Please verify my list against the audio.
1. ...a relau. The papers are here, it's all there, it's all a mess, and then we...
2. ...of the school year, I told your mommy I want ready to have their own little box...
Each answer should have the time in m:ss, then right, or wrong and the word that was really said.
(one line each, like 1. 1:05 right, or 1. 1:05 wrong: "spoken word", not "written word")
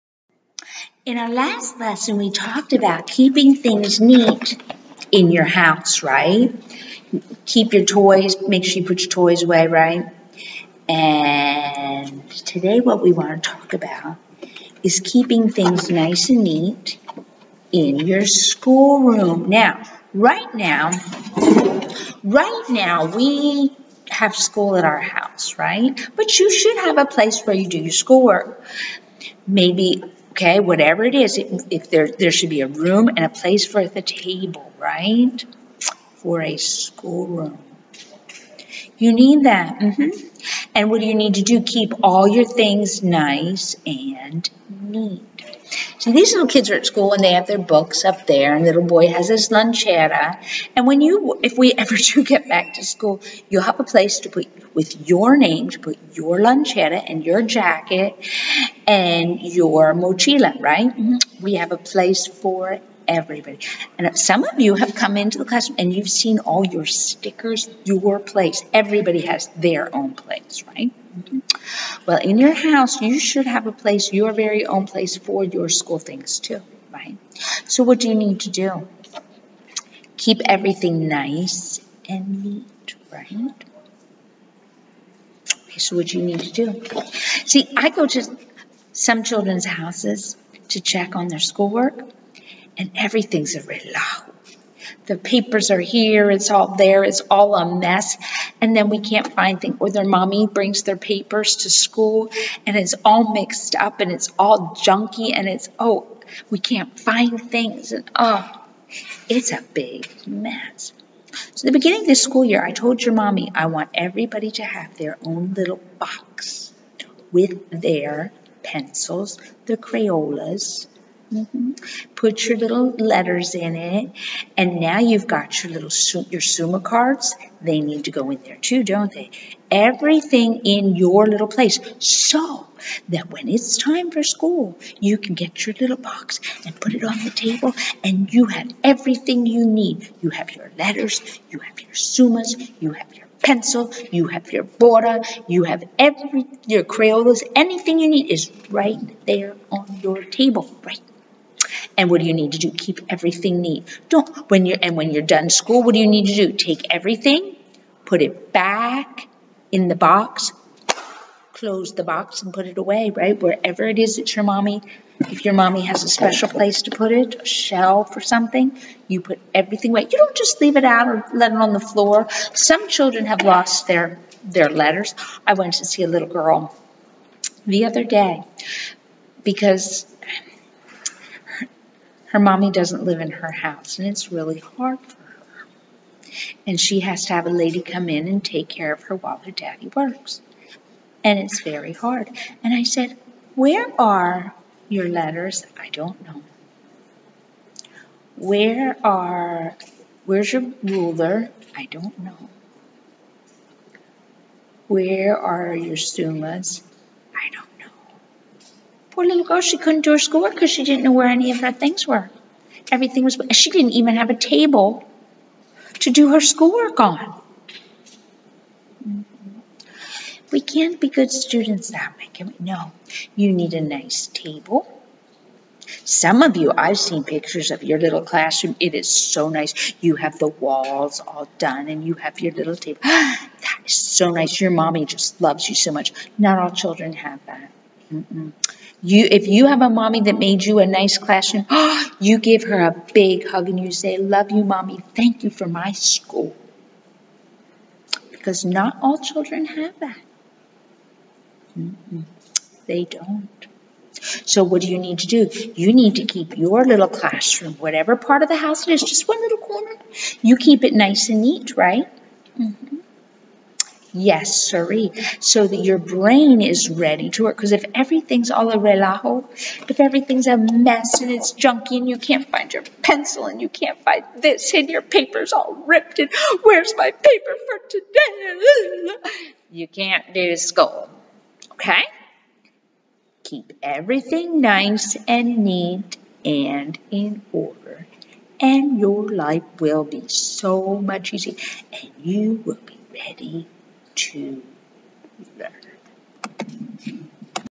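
1. 1:33 right
2. 1:52 wrong: "everybody", not "ready".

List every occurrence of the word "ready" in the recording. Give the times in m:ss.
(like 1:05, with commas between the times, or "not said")
4:26, 4:53.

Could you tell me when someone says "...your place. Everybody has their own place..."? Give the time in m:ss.
1:07.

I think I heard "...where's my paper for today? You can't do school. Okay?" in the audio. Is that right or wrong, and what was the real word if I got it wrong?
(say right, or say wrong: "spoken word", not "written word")
right.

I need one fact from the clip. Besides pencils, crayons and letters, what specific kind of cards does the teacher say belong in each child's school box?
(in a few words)
Summa cards.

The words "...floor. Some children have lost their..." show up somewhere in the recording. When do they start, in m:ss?
2:51.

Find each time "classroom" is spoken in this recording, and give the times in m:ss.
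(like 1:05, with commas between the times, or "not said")
1:05, 3:48, 4:01, 4:17.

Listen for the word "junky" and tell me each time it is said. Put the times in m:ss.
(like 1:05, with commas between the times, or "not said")
1:44, 4:31.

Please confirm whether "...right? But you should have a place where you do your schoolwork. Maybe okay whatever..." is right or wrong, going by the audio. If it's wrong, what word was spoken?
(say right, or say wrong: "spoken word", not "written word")
right.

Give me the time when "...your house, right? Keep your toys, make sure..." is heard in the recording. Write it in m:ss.
0:05.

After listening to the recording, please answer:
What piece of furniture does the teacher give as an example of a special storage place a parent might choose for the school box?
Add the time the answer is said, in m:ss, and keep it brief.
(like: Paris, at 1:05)
a shelf, at 2:47.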